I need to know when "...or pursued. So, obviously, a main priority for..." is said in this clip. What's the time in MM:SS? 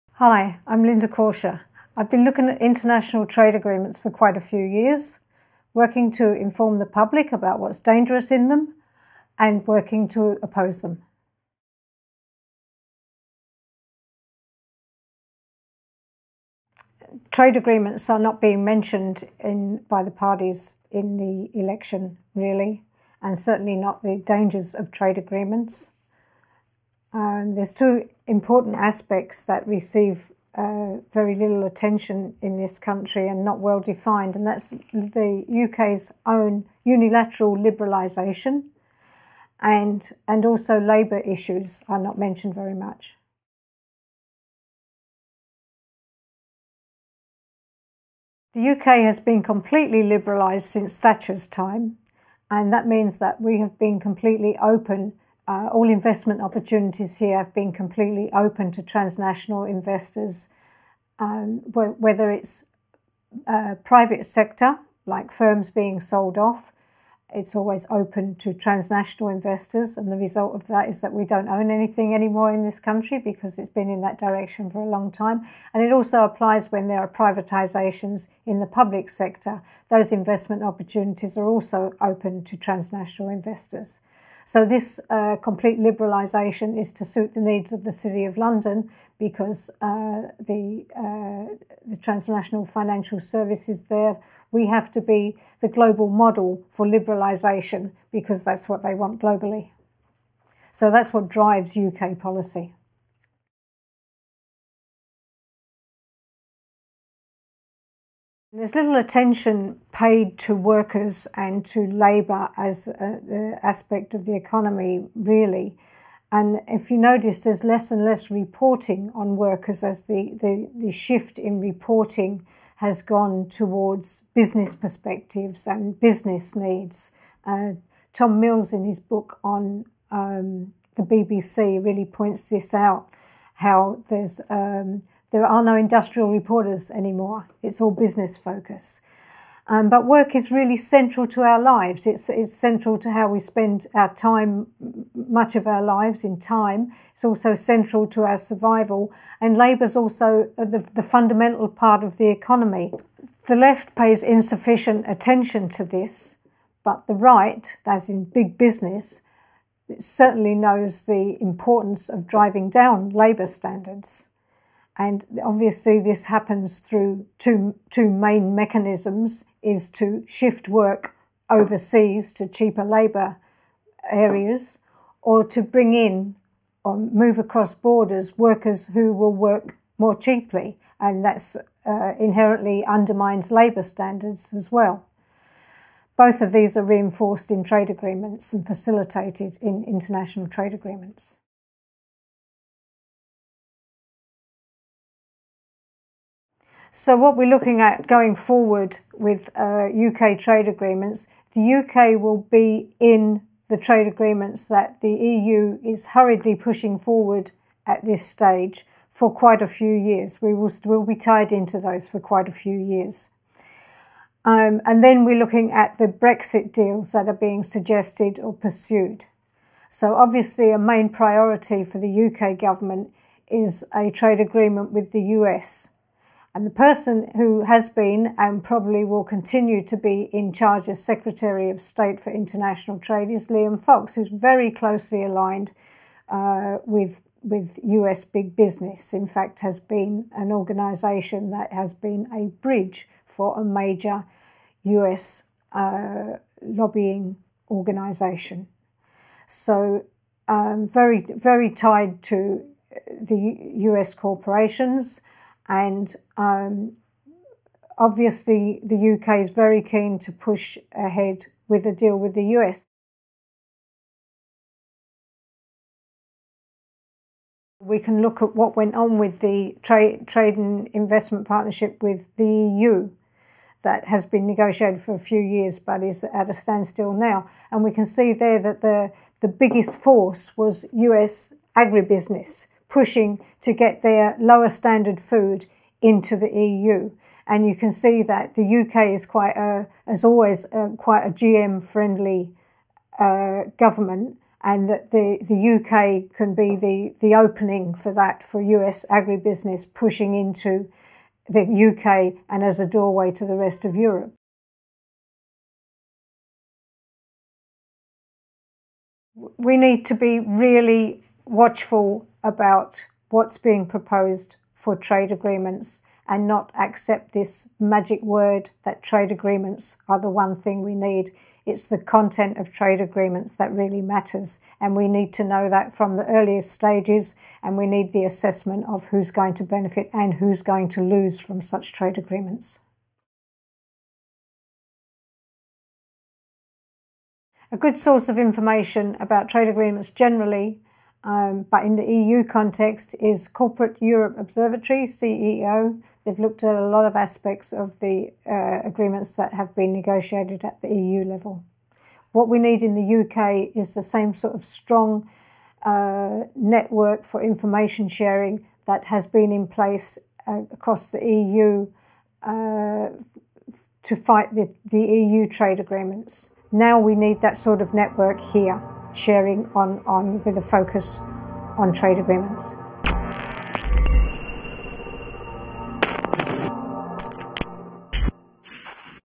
03:38.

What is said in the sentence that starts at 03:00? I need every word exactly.
And that's uh, inherently undermines labour standards as well.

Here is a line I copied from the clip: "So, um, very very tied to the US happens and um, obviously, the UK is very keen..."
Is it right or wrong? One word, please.
wrong.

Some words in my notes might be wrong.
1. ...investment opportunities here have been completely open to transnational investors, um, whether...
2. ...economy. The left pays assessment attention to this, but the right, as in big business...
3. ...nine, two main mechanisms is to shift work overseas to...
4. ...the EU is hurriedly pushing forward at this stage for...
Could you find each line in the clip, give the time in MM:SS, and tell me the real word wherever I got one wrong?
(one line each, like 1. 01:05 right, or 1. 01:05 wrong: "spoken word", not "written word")
1. 00:55 right
2. 02:32 wrong: "insufficient", not "assessment"
3. 02:47 wrong: "two", not "nine"
4. 03:25 right.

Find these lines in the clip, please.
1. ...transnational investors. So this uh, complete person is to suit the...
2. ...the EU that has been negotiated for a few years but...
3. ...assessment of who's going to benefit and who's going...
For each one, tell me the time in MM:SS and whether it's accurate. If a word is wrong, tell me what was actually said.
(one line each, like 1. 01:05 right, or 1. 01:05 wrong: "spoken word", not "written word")
1. 01:22 wrong: "liberalisation", not "person"
2. 04:32 right
3. 05:28 right.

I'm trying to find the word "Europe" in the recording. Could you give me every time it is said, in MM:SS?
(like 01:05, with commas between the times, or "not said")
05:03, 05:44.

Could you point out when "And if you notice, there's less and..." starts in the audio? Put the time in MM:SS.
01:56.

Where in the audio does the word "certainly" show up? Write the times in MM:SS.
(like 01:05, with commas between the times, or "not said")
00:23, 02:39.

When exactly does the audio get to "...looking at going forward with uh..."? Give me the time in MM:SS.
03:17.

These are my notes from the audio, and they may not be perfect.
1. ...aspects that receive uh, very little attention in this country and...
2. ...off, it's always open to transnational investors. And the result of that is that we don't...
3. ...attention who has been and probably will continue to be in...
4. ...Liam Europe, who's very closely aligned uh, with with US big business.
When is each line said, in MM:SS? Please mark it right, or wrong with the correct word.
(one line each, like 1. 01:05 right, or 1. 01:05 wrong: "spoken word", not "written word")
1. 00:28 right
2. 01:06 right
3. 03:46 wrong: "person", not "attention"
4. 03:53 wrong: "Fox", not "Europe".